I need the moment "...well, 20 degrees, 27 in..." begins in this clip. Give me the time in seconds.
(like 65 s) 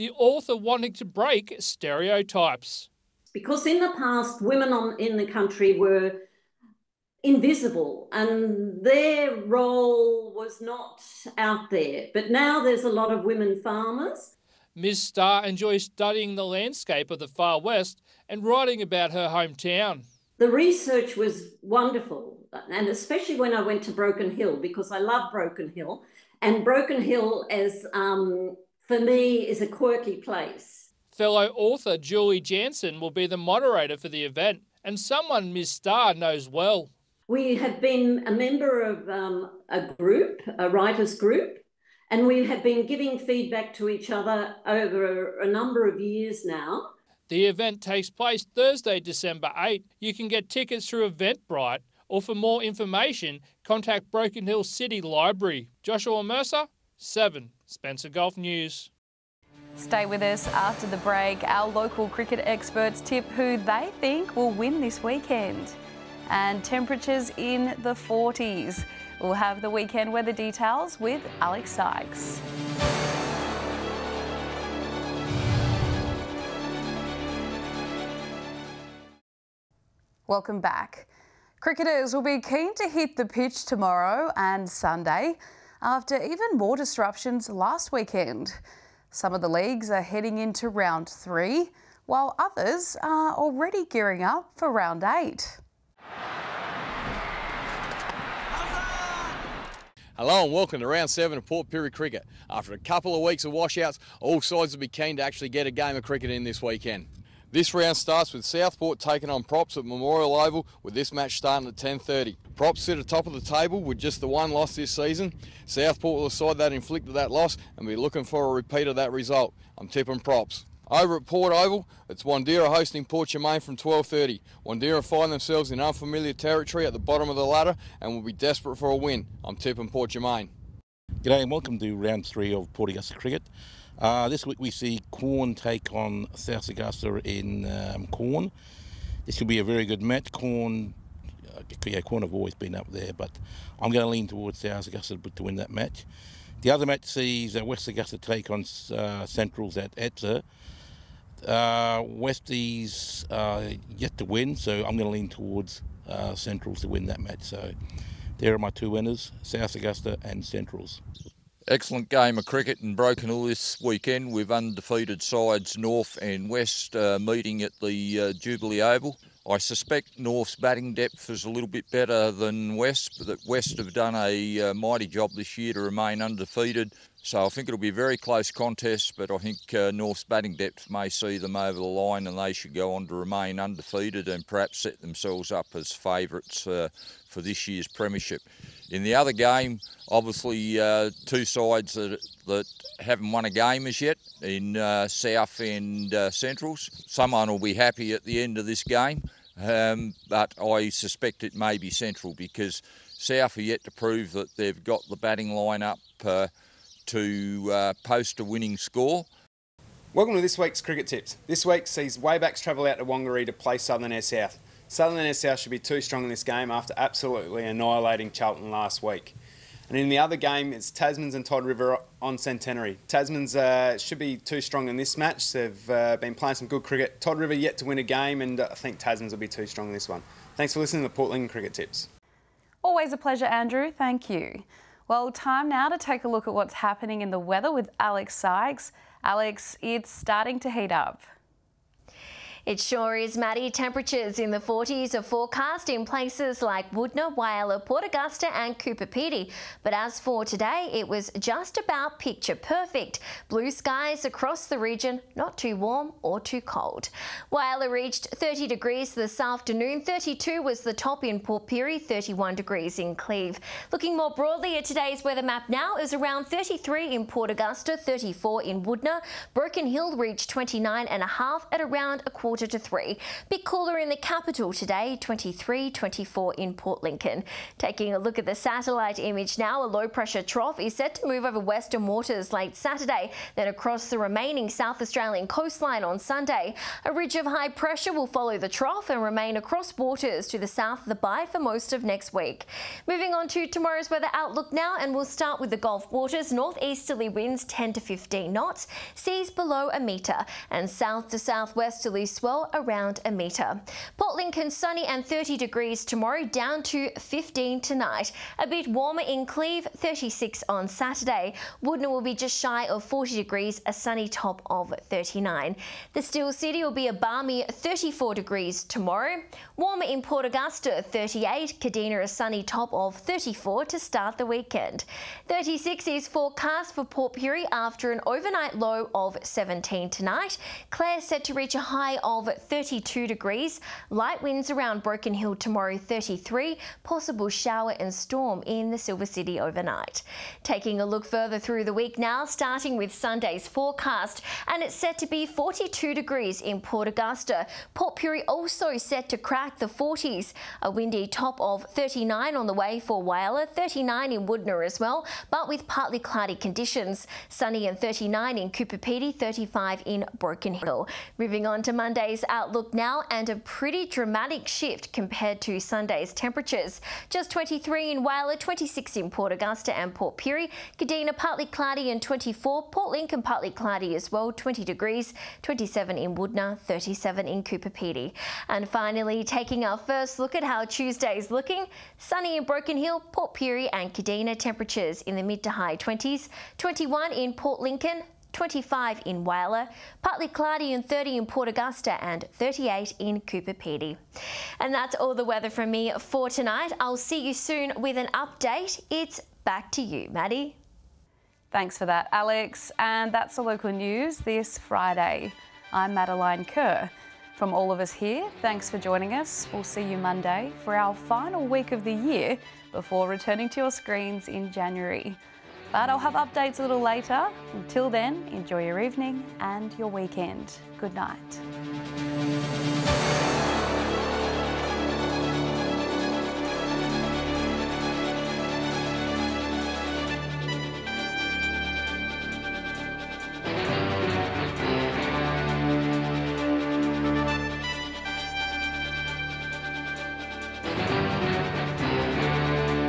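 374 s.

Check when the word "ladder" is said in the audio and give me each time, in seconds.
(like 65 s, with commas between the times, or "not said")
127 s.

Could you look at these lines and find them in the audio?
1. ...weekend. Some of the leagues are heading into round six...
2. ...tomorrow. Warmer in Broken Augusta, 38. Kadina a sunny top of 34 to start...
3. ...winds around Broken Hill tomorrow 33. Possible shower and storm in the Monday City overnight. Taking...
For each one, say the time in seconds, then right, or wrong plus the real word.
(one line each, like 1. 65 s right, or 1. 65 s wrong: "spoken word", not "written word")
1. 87 s wrong: "three", not "six"
2. 318 s wrong: "Port", not "Broken"
3. 334 s wrong: "Silver", not "Monday".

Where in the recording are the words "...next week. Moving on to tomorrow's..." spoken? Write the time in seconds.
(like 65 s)
292 s.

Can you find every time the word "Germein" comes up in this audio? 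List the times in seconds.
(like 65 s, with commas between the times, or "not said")
123 s, 130 s.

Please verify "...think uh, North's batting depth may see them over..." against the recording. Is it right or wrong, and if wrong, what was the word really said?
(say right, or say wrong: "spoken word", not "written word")
right.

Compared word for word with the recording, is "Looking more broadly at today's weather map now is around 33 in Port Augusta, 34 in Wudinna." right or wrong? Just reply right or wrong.
right.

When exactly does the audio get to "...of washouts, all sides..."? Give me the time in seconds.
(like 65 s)
103 s.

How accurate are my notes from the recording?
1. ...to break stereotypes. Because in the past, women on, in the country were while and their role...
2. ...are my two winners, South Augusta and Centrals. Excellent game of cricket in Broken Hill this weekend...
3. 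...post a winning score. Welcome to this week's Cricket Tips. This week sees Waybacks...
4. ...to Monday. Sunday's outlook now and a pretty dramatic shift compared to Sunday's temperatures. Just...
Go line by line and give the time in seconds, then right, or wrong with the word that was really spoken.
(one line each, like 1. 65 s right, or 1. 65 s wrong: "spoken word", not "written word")
1. 0 s wrong: "invisible", not "while"
2. 158 s right
3. 208 s right
4. 361 s right.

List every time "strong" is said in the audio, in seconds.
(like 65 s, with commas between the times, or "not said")
215 s, 224 s, 229 s.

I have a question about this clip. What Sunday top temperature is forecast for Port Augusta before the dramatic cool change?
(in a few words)
42 degrees.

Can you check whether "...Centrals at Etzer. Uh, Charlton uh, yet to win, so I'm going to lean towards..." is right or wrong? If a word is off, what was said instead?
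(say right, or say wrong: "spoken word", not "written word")
wrong: "Westies", not "Charlton".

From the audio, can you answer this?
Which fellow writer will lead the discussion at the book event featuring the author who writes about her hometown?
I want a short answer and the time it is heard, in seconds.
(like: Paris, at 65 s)
Julie Jansen, at 31 s.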